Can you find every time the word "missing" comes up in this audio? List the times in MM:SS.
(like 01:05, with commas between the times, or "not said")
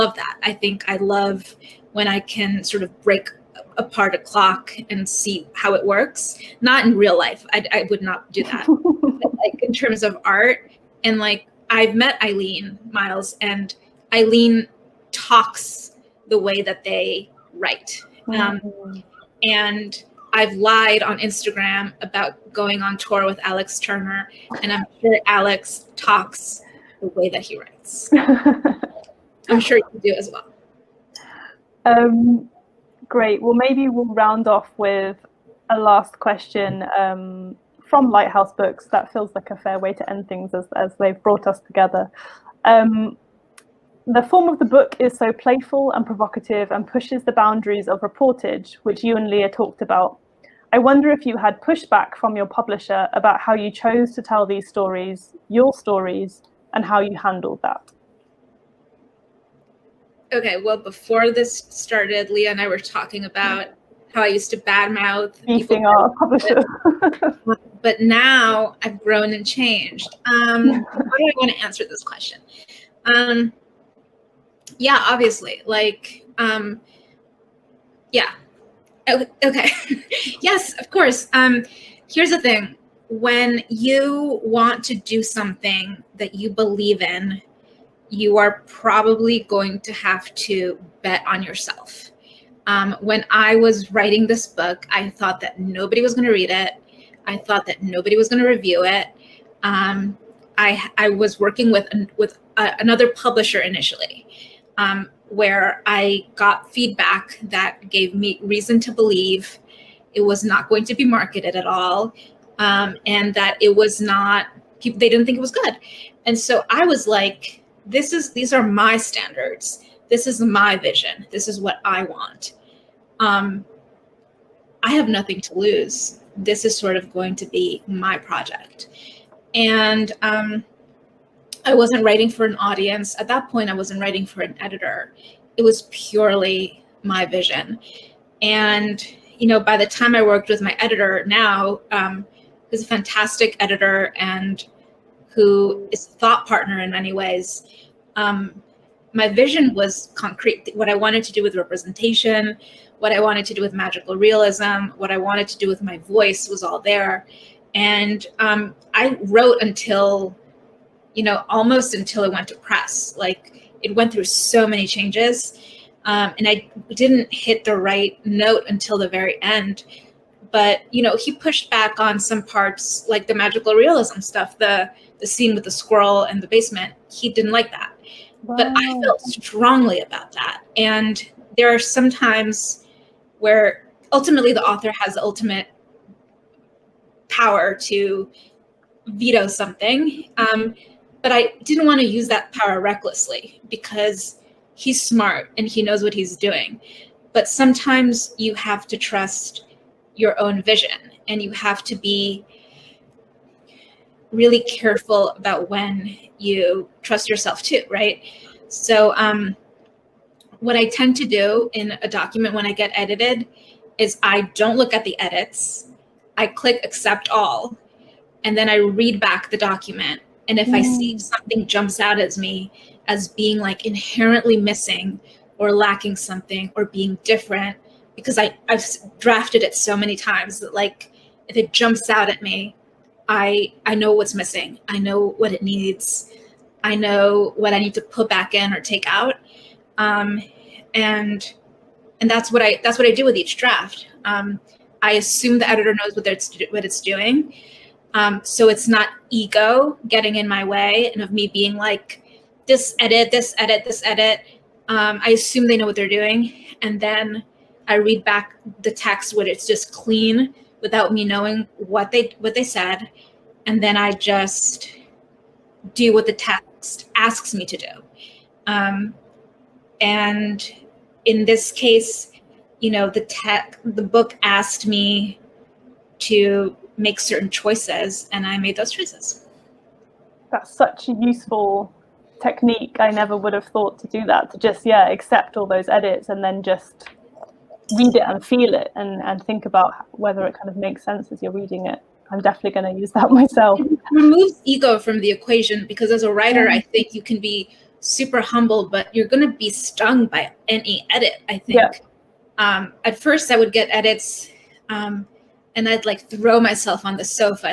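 03:44, 03:54.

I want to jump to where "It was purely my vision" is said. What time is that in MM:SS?
02:15.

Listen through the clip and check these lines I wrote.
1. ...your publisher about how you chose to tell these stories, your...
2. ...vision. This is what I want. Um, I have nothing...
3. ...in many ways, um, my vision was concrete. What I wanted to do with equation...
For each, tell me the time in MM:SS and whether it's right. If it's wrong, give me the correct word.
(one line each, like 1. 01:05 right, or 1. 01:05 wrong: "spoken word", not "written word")
1. 00:52 right
2. 02:00 right
3. 02:26 wrong: "representation", not "equation".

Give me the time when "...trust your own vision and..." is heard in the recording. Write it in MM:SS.
03:18.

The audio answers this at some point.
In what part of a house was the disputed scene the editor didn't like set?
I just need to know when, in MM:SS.
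02:56.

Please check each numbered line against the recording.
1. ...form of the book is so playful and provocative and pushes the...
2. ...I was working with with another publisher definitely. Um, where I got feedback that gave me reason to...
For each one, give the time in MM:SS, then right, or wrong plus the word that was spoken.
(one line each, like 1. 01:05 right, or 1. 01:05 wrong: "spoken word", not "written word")
1. 00:44 right
2. 01:40 wrong: "initially", not "definitely".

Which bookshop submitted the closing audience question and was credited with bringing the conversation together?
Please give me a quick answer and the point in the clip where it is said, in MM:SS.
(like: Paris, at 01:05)
Lighthouse Books, at 00:38.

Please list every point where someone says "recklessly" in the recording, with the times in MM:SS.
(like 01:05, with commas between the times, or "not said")
03:12.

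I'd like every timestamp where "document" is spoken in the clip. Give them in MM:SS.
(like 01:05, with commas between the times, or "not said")
03:32, 03:39.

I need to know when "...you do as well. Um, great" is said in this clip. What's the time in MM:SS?
00:29.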